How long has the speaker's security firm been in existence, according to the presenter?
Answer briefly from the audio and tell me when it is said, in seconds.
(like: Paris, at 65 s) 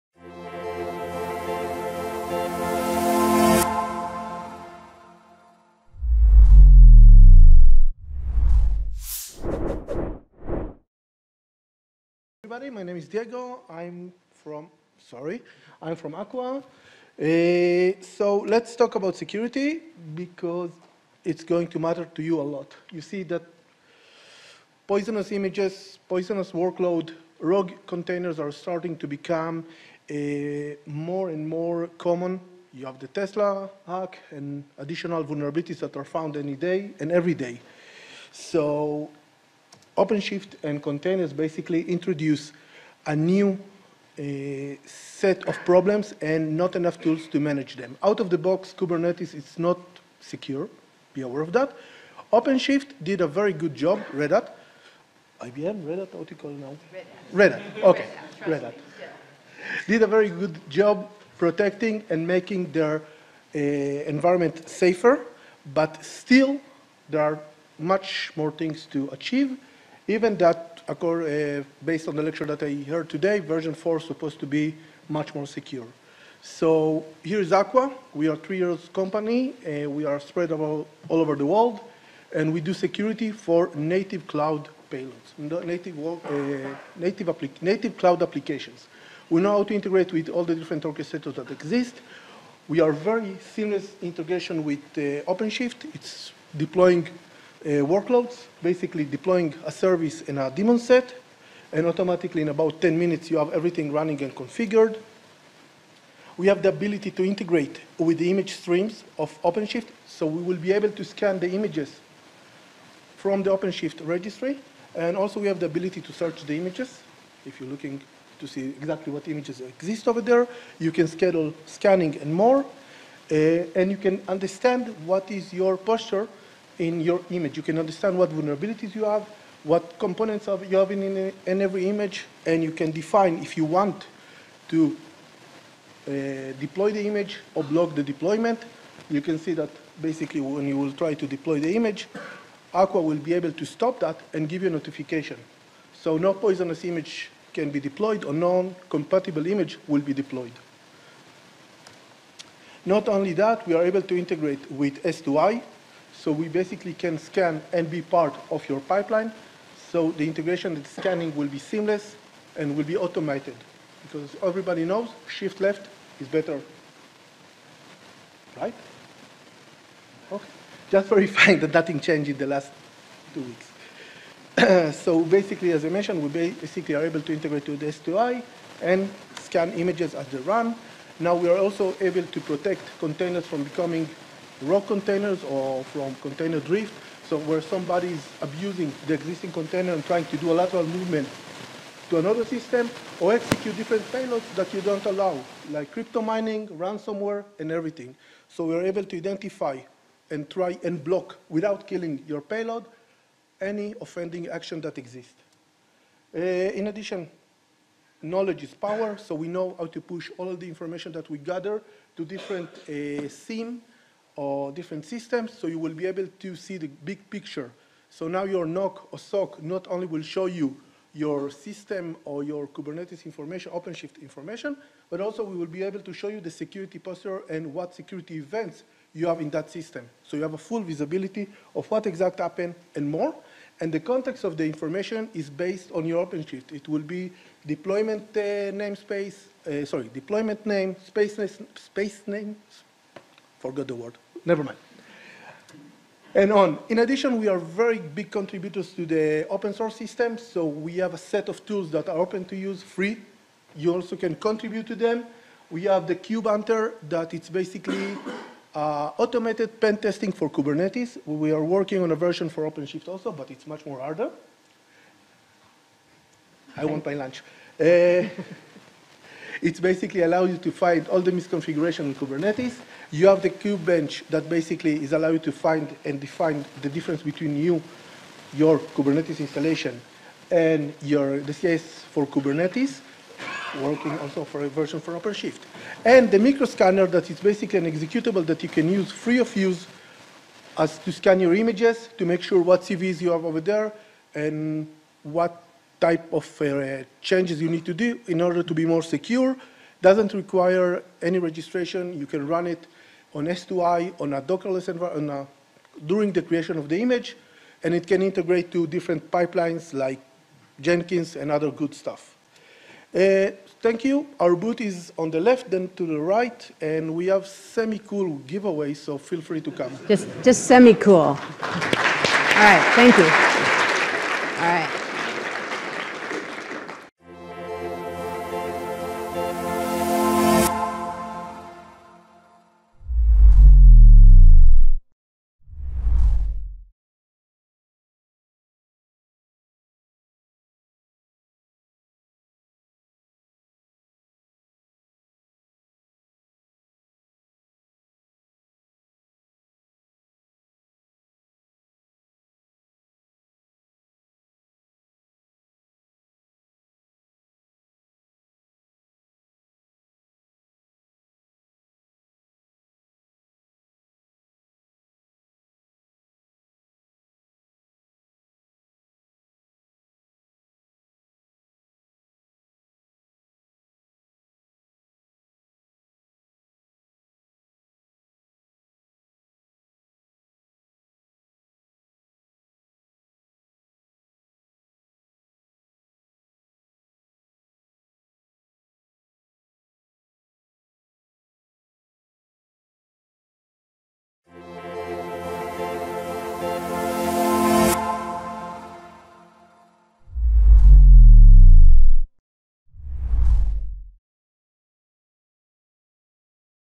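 3 years, at 78 s.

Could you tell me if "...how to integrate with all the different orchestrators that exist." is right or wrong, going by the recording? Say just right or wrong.
right.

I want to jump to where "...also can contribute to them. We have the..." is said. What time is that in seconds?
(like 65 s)
253 s.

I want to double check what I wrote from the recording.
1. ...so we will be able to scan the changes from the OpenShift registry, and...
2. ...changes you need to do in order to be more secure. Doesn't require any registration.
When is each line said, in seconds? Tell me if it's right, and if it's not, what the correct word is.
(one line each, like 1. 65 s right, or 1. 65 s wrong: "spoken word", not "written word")
1. 110 s wrong: "images", not "changes"
2. 297 s right.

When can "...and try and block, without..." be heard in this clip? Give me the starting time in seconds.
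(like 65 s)
200 s.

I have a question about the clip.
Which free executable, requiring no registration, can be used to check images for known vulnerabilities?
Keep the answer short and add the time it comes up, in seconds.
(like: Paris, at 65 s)
microscanner, at 286 s.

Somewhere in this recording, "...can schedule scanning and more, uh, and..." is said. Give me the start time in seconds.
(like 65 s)
120 s.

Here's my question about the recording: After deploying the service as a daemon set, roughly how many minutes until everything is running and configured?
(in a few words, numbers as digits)
10 minutes.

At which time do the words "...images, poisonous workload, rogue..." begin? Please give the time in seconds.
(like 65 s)
25 s.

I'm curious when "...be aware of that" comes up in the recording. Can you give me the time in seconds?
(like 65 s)
51 s.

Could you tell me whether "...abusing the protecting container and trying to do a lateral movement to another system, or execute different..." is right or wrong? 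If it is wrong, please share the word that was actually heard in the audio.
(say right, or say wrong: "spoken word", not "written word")
wrong: "existing", not "protecting".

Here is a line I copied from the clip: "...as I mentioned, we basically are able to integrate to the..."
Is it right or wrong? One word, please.
right.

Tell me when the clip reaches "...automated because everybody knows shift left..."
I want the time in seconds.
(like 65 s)
162 s.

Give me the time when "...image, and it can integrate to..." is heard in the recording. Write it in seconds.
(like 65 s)
306 s.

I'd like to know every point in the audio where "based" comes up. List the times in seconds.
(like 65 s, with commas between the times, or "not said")
71 s, 235 s.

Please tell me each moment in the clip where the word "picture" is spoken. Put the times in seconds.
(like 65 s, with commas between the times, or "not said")
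217 s.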